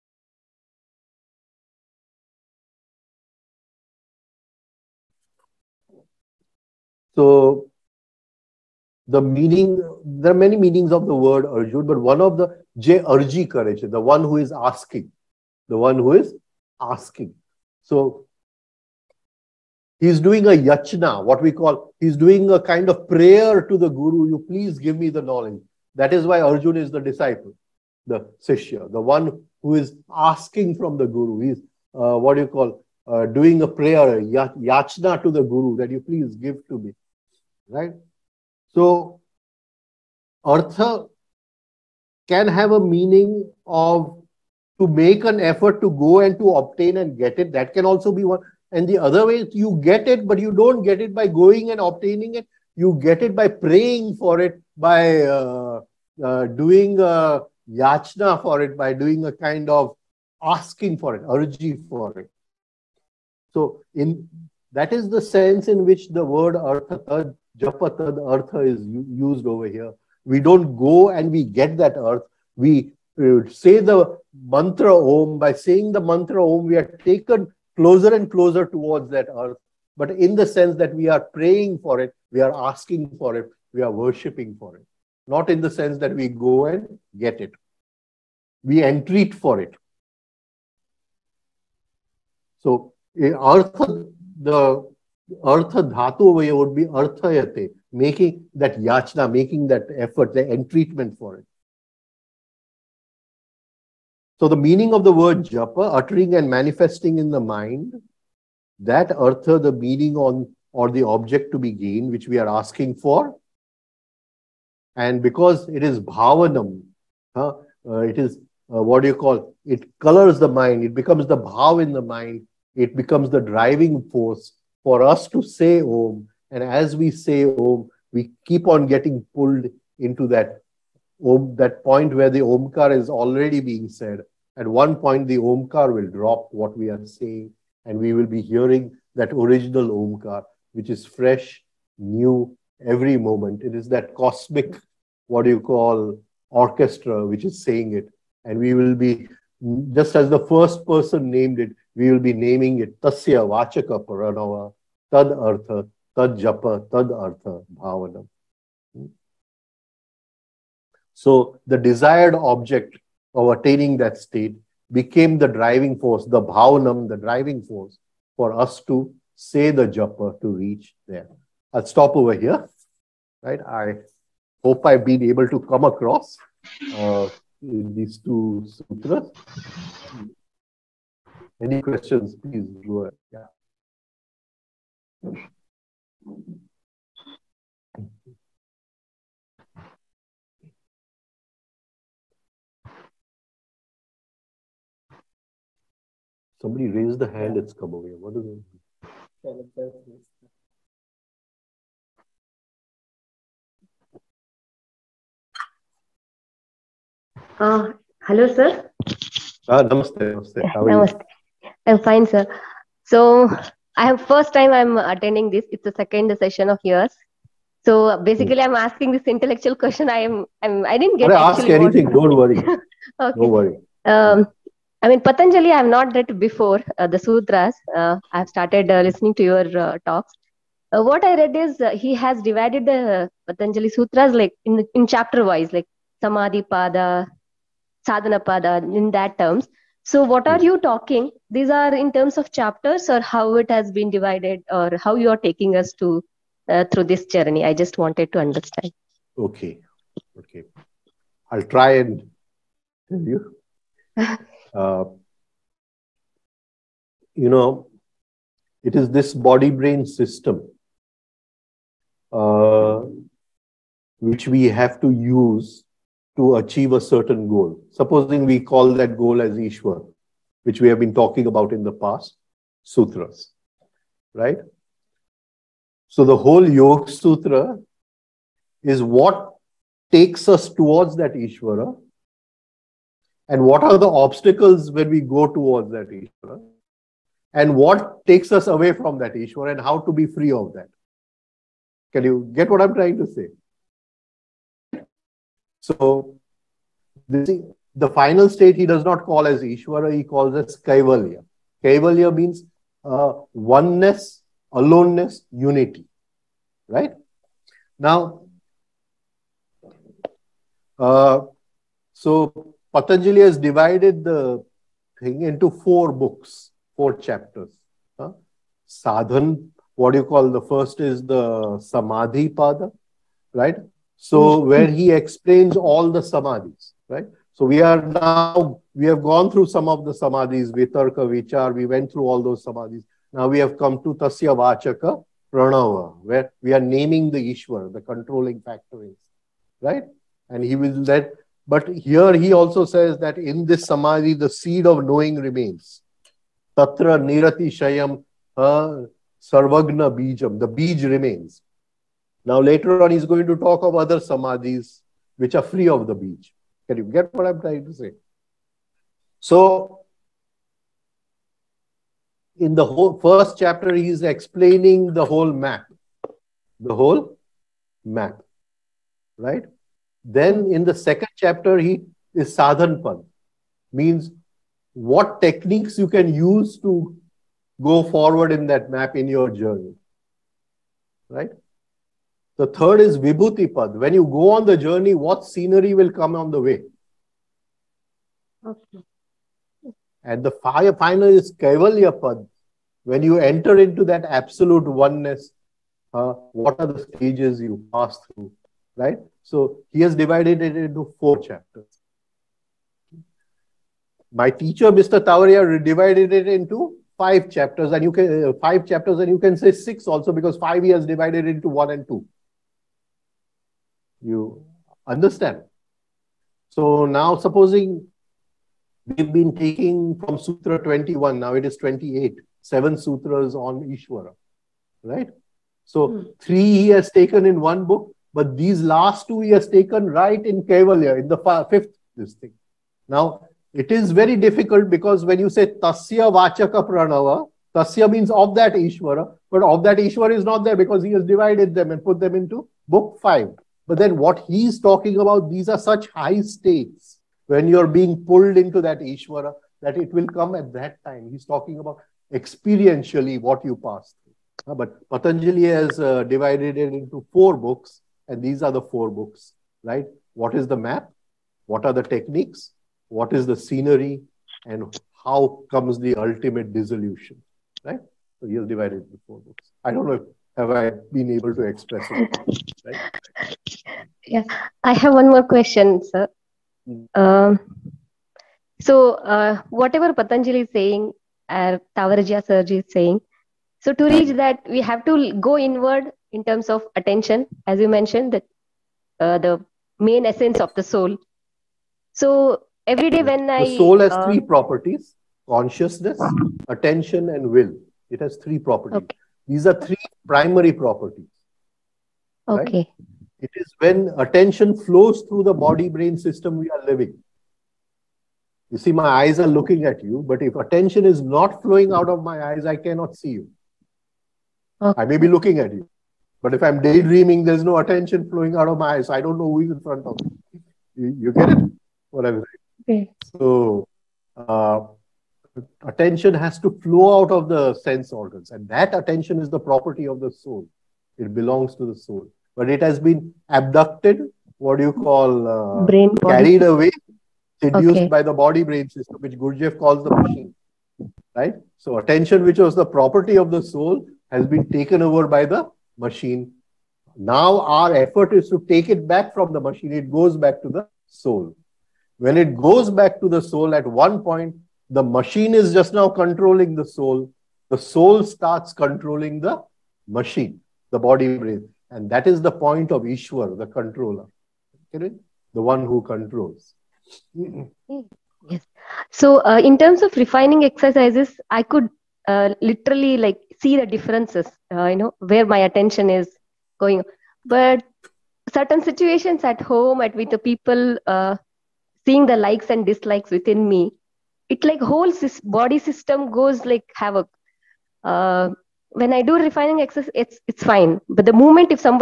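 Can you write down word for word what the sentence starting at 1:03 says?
So in that is the sense in which the word artha, japa, artha is used over here.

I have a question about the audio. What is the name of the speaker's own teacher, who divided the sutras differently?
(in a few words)
Mr. Tavaria.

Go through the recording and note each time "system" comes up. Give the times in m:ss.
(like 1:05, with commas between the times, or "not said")
4:20, 8:26, 8:58, 9:45.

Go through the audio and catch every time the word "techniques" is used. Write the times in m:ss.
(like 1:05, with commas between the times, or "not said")
6:15, 7:42.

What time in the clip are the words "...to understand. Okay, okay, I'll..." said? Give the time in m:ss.
4:08.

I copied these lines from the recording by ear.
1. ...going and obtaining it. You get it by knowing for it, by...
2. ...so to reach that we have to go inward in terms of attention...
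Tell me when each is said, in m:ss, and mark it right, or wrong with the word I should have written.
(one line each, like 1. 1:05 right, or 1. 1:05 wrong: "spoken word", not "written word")
1. 0:51 wrong: "praying", not "knowing"
2. 8:03 right.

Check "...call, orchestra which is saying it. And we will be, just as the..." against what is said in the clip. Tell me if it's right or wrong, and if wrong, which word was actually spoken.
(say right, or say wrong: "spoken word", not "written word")
right.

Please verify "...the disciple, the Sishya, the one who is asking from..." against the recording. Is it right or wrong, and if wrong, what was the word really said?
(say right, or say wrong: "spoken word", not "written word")
right.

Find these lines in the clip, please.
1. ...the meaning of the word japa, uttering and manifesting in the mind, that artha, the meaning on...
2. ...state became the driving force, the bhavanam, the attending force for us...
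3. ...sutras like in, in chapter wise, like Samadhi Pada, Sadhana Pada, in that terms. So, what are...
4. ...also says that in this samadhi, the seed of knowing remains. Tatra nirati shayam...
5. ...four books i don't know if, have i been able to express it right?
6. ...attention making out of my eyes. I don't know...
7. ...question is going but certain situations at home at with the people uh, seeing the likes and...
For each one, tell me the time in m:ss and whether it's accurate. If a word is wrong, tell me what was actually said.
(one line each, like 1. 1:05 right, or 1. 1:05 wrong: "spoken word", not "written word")
1. 1:44 right
2. 2:44 wrong: "driving", not "attending"
3. 3:53 right
4. 5:42 right
5. 7:49 right
6. 8:37 wrong: "flowing", not "making"
7. 9:35 wrong: "attention", not "question".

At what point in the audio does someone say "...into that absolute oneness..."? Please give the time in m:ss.
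6:33.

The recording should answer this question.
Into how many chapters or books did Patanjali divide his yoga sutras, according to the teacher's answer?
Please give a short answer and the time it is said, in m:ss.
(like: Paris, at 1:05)
4, at 5:15.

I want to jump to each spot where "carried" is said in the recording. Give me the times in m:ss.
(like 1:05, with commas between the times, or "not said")
8:56.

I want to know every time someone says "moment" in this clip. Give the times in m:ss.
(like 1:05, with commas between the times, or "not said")
2:23, 9:51.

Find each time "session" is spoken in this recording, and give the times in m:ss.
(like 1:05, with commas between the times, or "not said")
3:36.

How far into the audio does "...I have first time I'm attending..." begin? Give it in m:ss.
3:33.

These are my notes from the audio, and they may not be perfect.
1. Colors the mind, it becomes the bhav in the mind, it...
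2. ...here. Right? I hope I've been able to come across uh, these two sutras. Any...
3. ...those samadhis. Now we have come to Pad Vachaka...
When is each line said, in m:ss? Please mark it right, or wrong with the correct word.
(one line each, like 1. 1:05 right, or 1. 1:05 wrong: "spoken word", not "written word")
1. 1:59 right
2. 2:52 right
3. 5:32 wrong: "Tasya", not "Pad".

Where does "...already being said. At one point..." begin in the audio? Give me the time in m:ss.
2:13.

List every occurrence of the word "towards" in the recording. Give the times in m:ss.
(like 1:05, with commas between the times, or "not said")
1:18, 4:40, 4:45.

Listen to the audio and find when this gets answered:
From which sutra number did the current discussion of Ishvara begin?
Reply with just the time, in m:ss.
7:00.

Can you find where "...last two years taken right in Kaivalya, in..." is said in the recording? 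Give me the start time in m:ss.
7:08.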